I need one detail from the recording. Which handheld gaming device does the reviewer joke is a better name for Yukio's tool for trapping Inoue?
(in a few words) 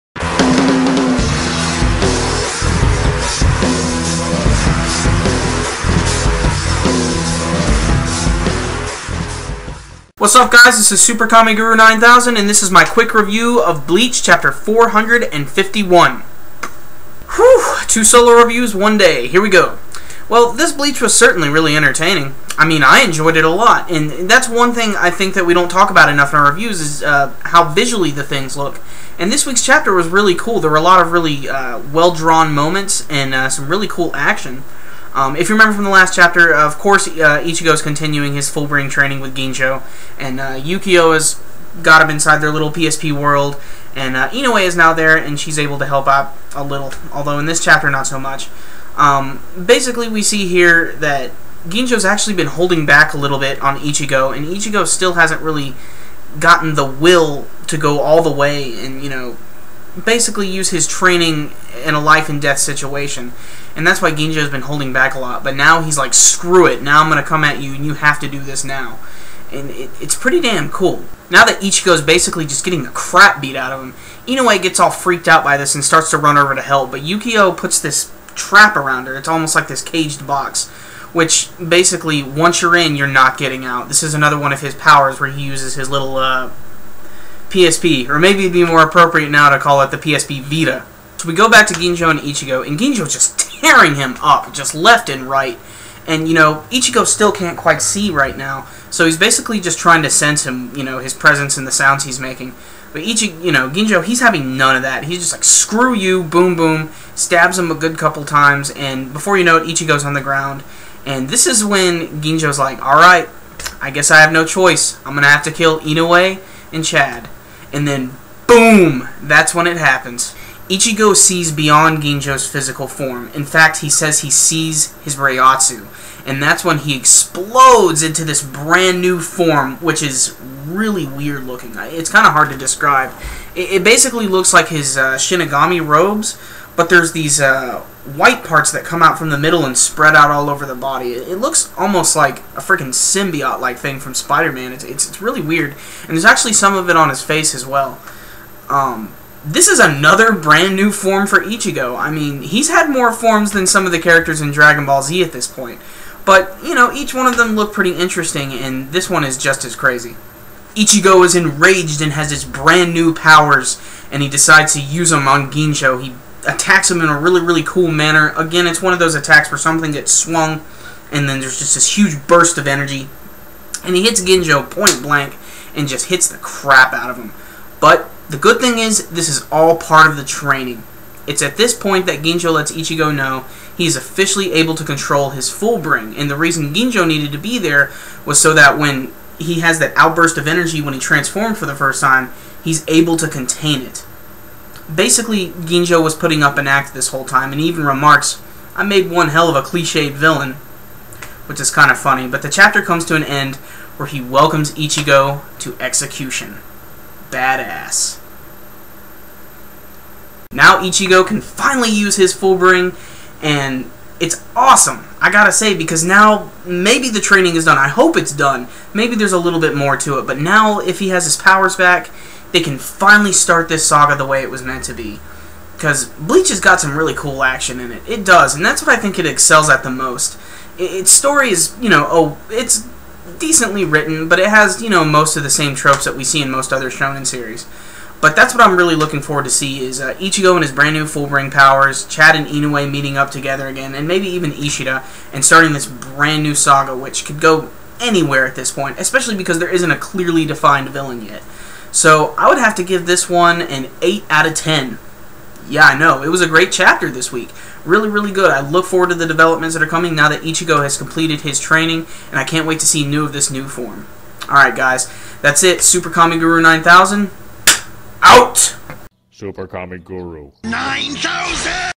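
PSP Vita.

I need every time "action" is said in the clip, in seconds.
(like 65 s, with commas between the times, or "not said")
34 s, 227 s.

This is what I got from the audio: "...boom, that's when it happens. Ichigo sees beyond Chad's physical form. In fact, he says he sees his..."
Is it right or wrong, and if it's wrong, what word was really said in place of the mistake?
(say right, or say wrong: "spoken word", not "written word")
wrong: "Ginjo", not "Chad".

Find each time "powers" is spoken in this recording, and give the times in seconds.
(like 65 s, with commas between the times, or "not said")
84 s, 163 s, 221 s, 241 s.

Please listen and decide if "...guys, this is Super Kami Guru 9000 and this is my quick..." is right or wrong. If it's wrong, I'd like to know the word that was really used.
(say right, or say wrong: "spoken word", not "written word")
right.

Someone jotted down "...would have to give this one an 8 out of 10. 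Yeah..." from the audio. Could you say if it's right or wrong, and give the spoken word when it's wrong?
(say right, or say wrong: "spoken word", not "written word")
right.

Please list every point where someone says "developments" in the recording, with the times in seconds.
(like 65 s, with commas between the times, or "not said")
259 s.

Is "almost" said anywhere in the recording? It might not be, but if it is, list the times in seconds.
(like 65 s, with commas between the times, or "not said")
79 s, 141 s.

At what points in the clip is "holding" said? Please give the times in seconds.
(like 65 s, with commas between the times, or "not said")
52 s, 64 s.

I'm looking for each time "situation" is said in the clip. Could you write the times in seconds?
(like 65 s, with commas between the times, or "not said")
62 s.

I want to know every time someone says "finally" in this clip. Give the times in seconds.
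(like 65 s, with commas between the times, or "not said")
211 s, 222 s.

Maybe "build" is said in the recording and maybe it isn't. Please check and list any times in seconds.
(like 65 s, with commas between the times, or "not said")
not said.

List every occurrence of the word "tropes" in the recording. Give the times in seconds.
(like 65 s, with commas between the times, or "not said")
235 s.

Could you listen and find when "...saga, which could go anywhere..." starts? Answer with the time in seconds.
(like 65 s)
246 s.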